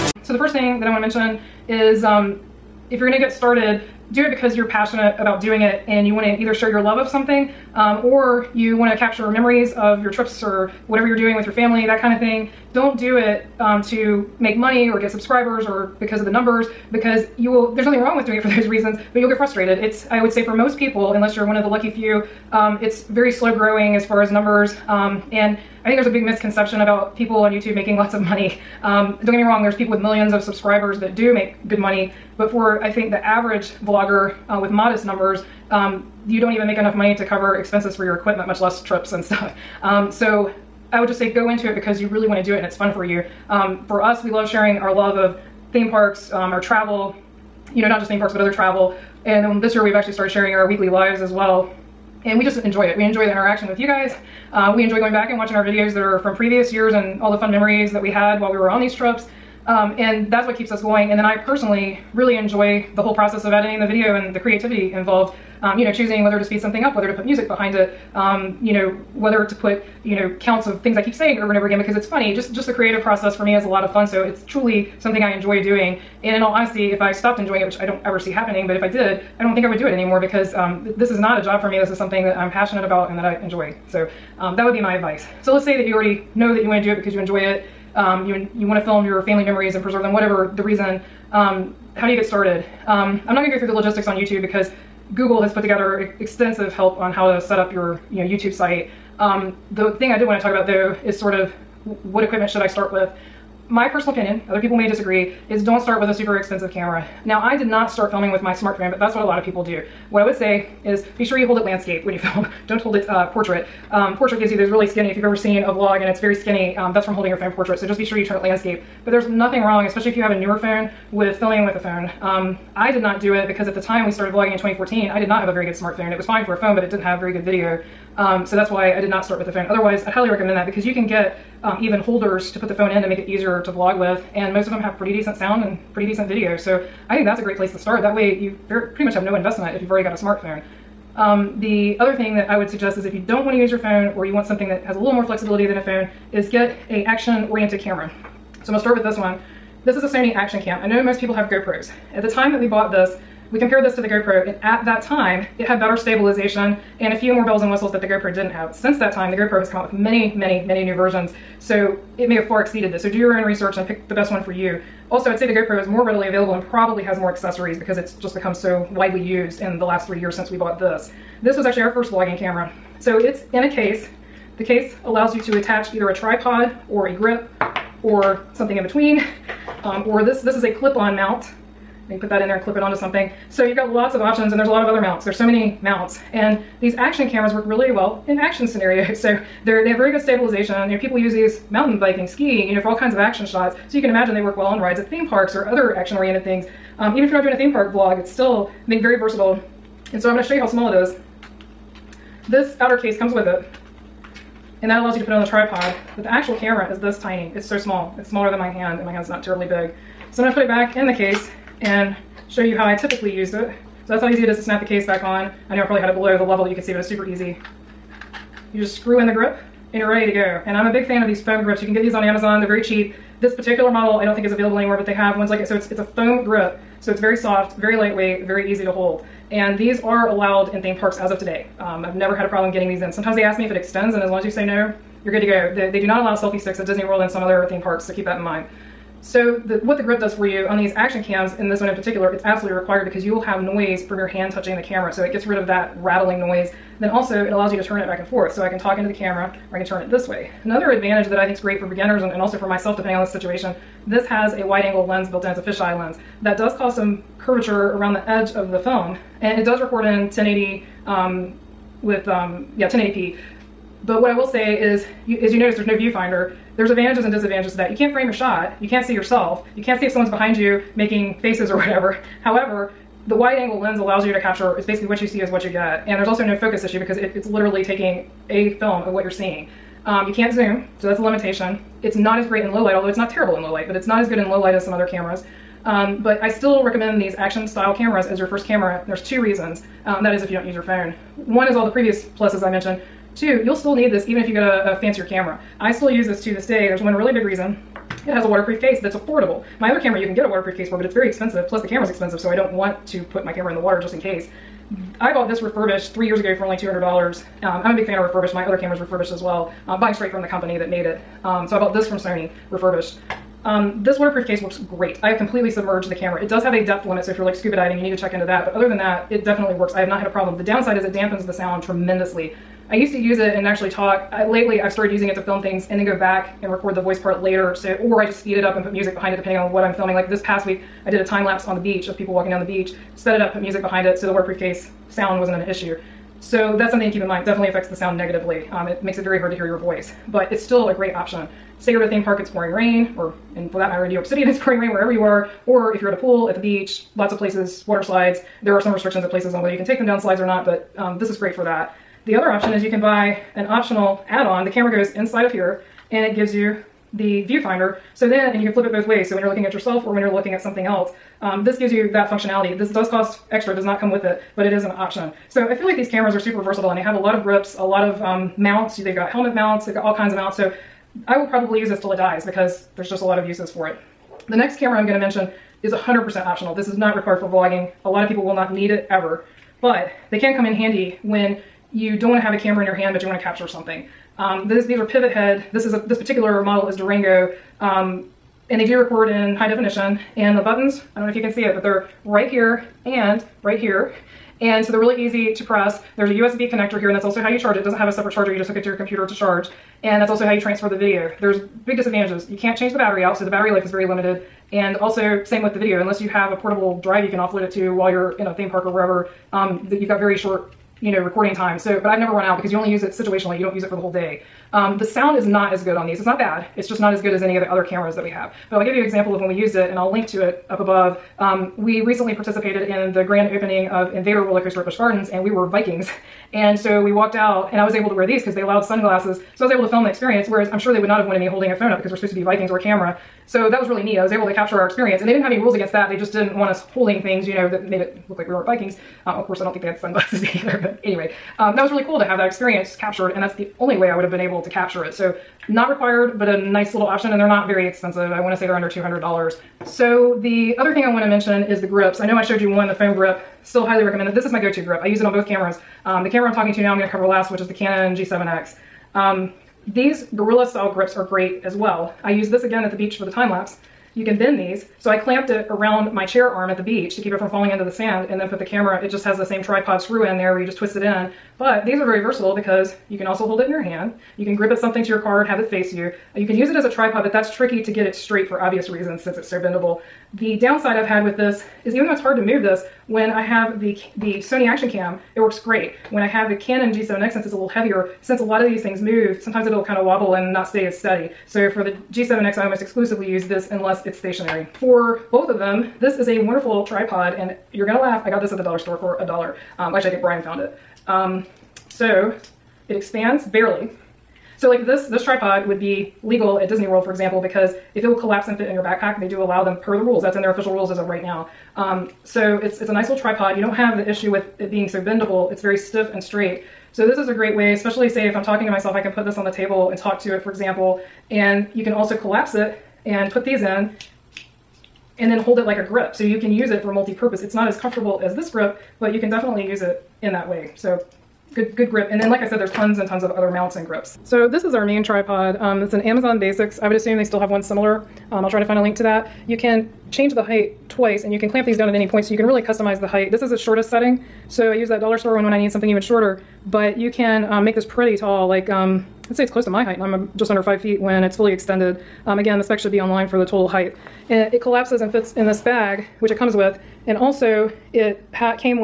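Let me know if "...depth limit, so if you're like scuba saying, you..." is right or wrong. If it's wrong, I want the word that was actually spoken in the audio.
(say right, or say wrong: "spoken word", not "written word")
wrong: "diving", not "saying".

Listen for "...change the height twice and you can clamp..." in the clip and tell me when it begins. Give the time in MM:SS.
09:00.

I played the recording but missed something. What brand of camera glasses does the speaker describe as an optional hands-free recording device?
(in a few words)
Pivothead.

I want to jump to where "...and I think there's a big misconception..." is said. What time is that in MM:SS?
00:25.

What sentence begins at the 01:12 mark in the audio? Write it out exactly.
Just just the creative process for me is a lot of fun, so it's truly something I enjoy doing.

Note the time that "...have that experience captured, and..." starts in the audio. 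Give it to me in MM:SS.
07:22.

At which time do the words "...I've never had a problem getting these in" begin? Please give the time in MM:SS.
03:52.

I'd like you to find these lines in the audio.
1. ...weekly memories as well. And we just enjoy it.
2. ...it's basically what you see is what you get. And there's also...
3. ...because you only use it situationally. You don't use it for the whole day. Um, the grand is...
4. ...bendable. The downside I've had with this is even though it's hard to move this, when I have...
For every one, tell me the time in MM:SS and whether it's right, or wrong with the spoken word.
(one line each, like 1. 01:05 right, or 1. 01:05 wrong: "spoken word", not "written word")
1. 00:50 wrong: "lives", not "memories"
2. 04:34 right
3. 06:52 wrong: "sound", not "grand"
4. 07:59 right.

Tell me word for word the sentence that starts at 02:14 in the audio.
And most of them have pretty decent sound and pretty decent video.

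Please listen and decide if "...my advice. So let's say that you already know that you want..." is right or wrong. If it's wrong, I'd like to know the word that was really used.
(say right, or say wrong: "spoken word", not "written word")
right.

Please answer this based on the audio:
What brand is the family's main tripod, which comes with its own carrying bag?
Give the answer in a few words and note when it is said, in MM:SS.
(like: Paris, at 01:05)
Amazon Basics, at 08:56.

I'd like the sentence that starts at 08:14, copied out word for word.
For both of them, this is a wonderful tripod and you're gonna laugh.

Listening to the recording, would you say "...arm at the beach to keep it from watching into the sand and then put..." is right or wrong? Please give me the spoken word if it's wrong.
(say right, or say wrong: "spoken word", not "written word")
wrong: "falling", not "watching".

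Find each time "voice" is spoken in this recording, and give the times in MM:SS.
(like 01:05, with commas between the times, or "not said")
05:27, 05:39.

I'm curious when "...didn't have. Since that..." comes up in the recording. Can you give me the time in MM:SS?
02:38.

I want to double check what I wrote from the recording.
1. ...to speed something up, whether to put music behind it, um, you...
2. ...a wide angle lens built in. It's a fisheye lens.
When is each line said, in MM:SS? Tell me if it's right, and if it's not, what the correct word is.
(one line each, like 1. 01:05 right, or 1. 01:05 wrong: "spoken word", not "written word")
1. 01:06 right
2. 04:14 right.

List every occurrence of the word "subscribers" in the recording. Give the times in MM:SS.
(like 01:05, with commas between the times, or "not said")
00:15, 00:30.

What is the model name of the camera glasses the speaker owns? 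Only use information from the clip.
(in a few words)
Durango.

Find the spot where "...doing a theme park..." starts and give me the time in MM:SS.
03:17.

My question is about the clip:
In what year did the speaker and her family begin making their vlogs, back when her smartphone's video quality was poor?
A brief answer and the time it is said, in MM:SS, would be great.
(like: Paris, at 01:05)
2014, at 02:04.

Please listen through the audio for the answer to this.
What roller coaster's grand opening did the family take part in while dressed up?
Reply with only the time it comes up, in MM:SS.
07:04.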